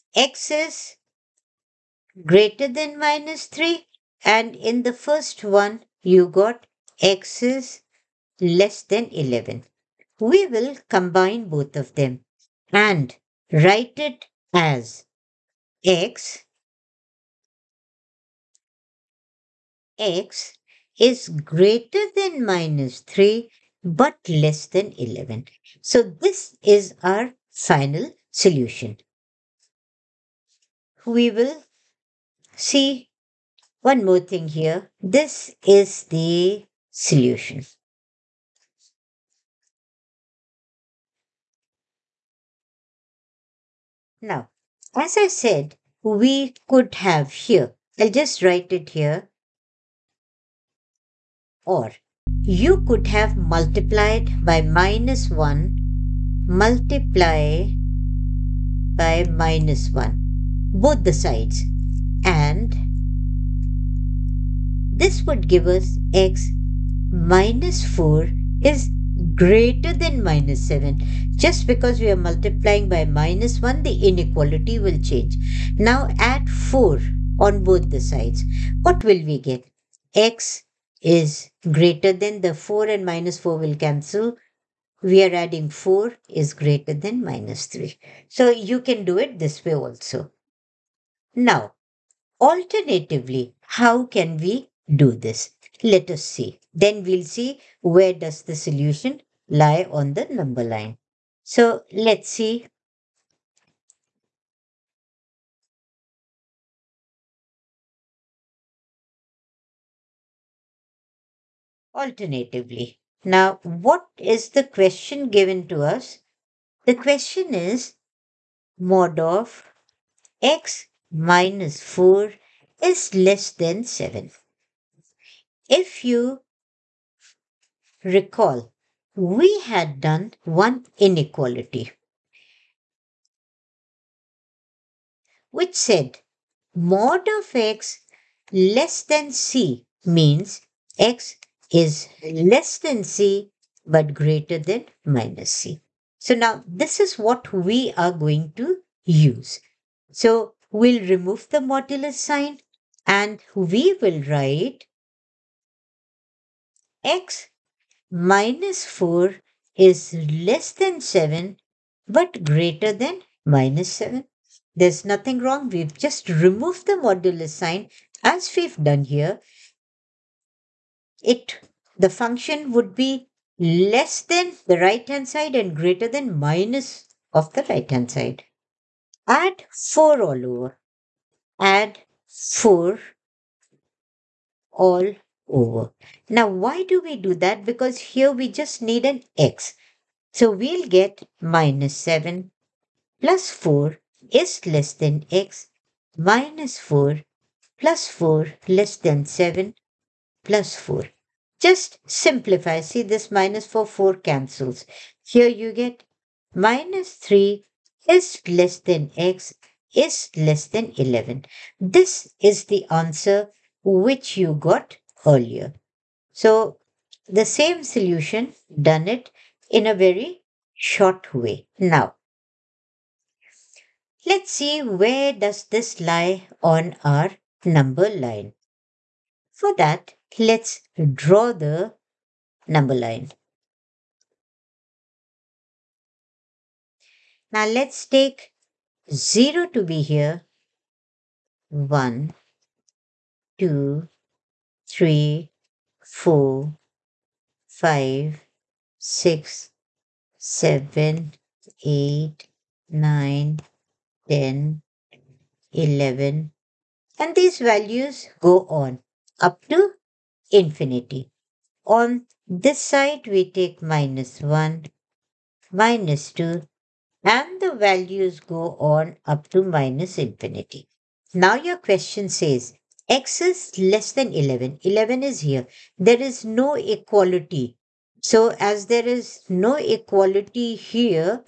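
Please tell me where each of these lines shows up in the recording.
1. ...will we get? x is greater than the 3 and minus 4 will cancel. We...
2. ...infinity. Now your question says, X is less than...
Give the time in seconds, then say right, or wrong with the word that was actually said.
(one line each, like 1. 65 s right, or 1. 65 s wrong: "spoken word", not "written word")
1. 79 s wrong: "4", not "3"
2. 270 s right.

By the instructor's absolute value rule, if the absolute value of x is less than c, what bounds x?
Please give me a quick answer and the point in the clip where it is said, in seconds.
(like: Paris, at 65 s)
less than c but greater than minus c, at 140 s.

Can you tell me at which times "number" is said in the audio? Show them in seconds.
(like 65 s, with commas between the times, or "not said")
100 s, 227 s, 232 s.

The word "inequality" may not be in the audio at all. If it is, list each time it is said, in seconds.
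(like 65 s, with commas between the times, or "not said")
73 s, 130 s.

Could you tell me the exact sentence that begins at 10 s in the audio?
We will combine both of them and write it as x x is greater than minus 3 but less than 11.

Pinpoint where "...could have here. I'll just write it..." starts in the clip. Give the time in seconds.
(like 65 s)
46 s.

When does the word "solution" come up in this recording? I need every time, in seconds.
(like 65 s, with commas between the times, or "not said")
28 s, 36 s, 98 s, 217 s.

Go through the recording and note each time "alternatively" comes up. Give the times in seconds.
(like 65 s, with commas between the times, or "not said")
92 s, 111 s.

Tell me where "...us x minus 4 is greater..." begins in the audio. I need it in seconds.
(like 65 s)
65 s.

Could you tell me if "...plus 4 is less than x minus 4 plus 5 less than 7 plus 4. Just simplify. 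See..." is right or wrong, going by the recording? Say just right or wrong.
wrong.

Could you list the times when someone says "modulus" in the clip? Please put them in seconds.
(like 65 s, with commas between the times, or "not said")
151 s, 166 s.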